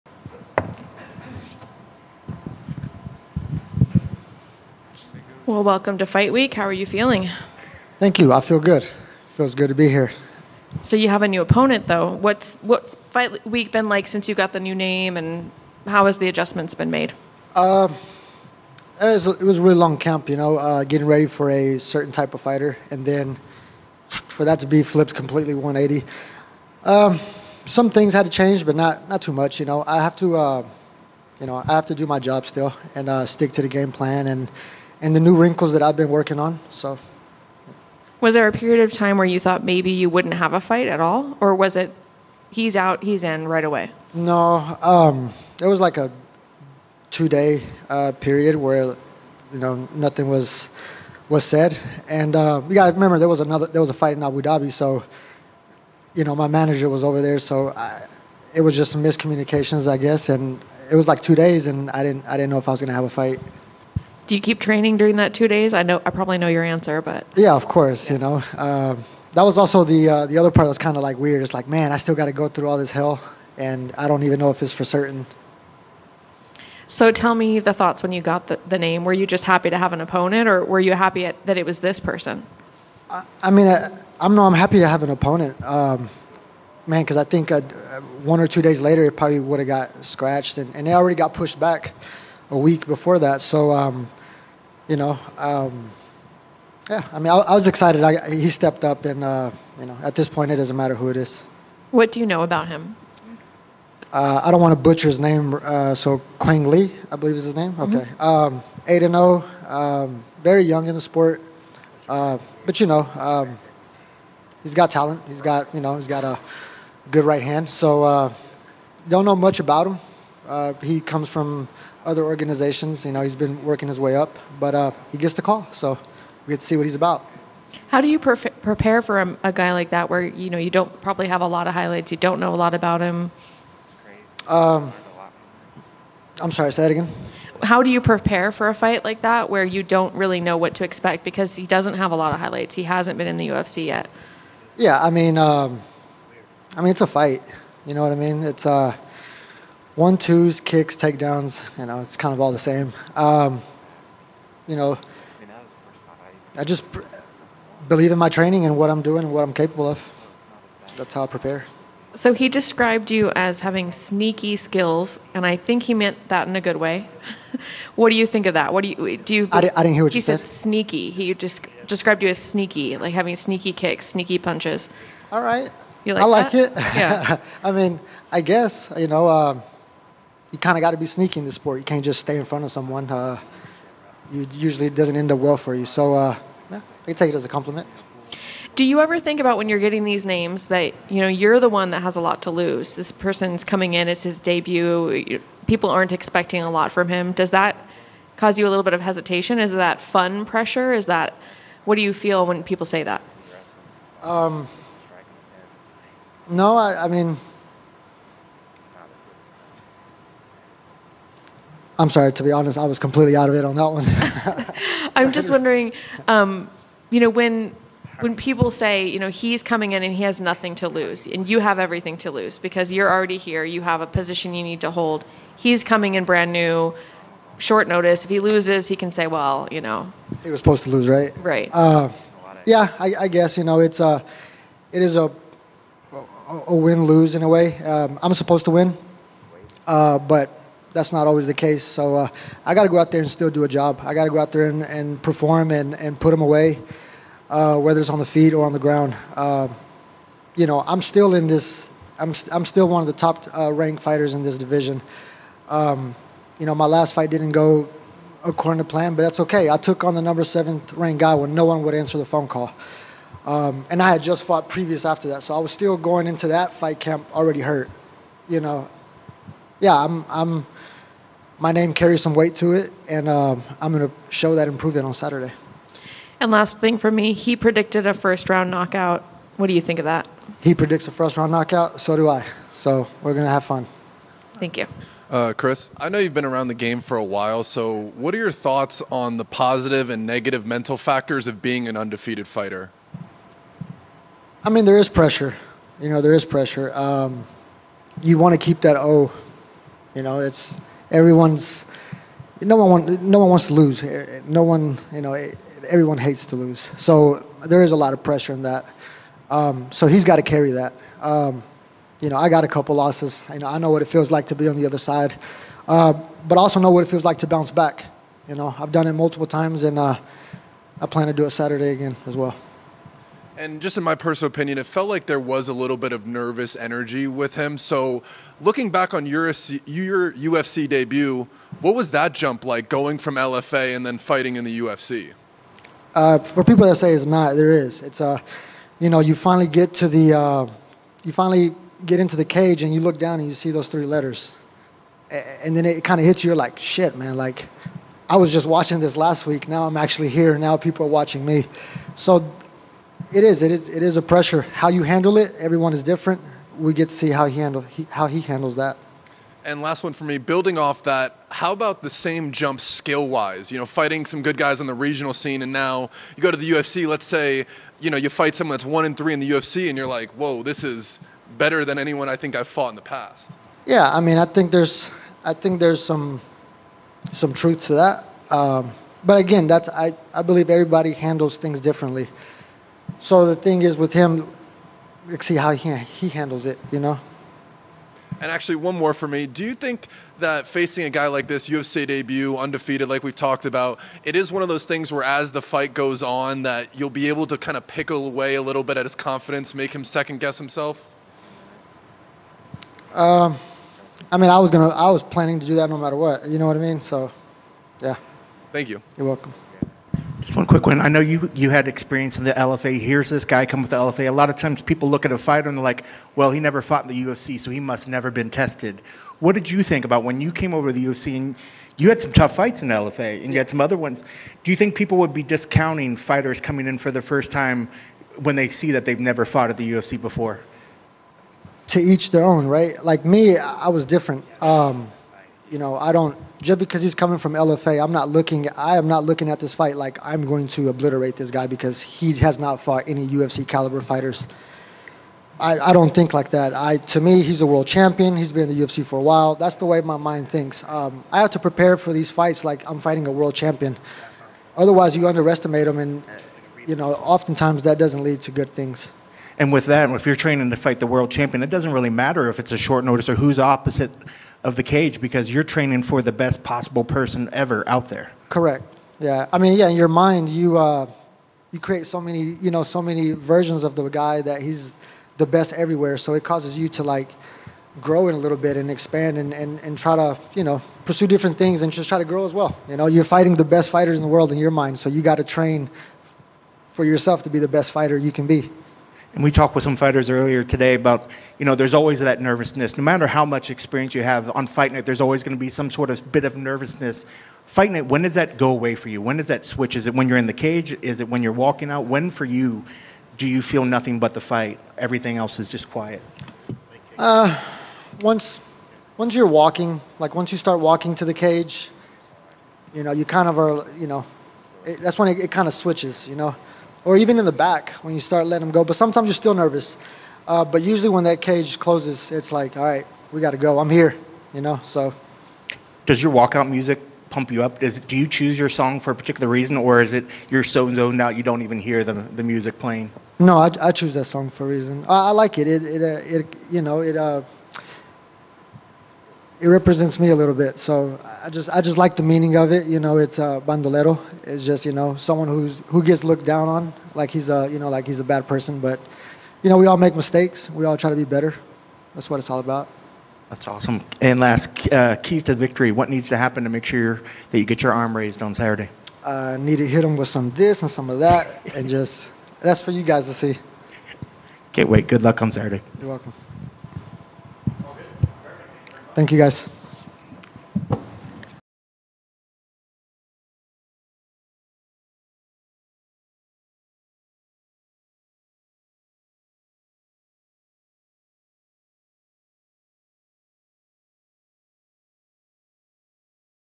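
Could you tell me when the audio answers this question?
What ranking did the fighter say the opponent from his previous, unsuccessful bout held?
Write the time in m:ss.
4:20.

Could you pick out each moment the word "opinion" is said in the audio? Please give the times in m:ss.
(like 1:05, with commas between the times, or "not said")
5:24.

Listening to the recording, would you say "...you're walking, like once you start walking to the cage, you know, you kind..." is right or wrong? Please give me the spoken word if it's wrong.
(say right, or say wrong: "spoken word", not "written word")
right.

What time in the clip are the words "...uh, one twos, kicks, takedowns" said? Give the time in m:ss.
2:28.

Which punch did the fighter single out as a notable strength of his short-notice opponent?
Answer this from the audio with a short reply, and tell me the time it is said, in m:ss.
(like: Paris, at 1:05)
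right hand, at 1:57.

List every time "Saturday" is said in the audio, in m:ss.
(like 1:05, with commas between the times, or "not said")
4:35, 5:21, 9:18, 9:25.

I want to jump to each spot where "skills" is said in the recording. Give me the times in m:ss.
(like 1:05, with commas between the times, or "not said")
2:44, 6:02.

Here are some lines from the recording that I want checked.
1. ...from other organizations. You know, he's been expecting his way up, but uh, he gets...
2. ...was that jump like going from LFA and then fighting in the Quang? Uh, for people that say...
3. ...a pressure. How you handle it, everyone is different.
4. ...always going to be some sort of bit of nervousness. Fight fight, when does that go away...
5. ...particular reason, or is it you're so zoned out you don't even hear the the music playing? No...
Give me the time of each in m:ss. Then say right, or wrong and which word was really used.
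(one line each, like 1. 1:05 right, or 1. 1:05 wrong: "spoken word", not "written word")
1. 2:01 wrong: "working", not "expecting"
2. 5:31 wrong: "UFC", not "Quang"
3. 5:54 right
4. 8:15 wrong: "night", not "fight"
5. 8:49 right.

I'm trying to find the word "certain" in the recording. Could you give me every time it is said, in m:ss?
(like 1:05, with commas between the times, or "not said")
0:21, 1:14.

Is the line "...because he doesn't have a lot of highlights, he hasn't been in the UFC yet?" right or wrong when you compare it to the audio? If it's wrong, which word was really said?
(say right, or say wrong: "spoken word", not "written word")
right.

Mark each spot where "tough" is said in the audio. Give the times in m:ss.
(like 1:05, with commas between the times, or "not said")
7:02.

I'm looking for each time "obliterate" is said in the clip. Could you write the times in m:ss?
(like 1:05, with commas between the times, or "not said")
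7:20.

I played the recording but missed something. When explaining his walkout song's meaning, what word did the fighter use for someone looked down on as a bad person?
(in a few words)
bandolero.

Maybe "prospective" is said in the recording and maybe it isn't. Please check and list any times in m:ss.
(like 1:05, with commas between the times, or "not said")
not said.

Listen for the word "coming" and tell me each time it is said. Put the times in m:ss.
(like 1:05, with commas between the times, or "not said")
3:13, 3:39, 3:45, 7:06, 7:17.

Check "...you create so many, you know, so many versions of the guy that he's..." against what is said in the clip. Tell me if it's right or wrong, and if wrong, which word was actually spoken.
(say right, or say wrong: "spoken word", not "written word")
right.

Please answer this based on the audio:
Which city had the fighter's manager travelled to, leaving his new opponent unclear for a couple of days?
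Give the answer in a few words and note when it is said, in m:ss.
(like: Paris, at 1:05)
Abu Dhabi, at 0:54.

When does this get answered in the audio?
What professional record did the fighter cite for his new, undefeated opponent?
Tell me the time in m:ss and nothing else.
1:48.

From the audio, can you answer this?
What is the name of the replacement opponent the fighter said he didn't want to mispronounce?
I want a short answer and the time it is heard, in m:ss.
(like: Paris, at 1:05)
Quang Le, at 1:46.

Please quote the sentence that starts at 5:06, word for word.
So there is a lot of pressure in that.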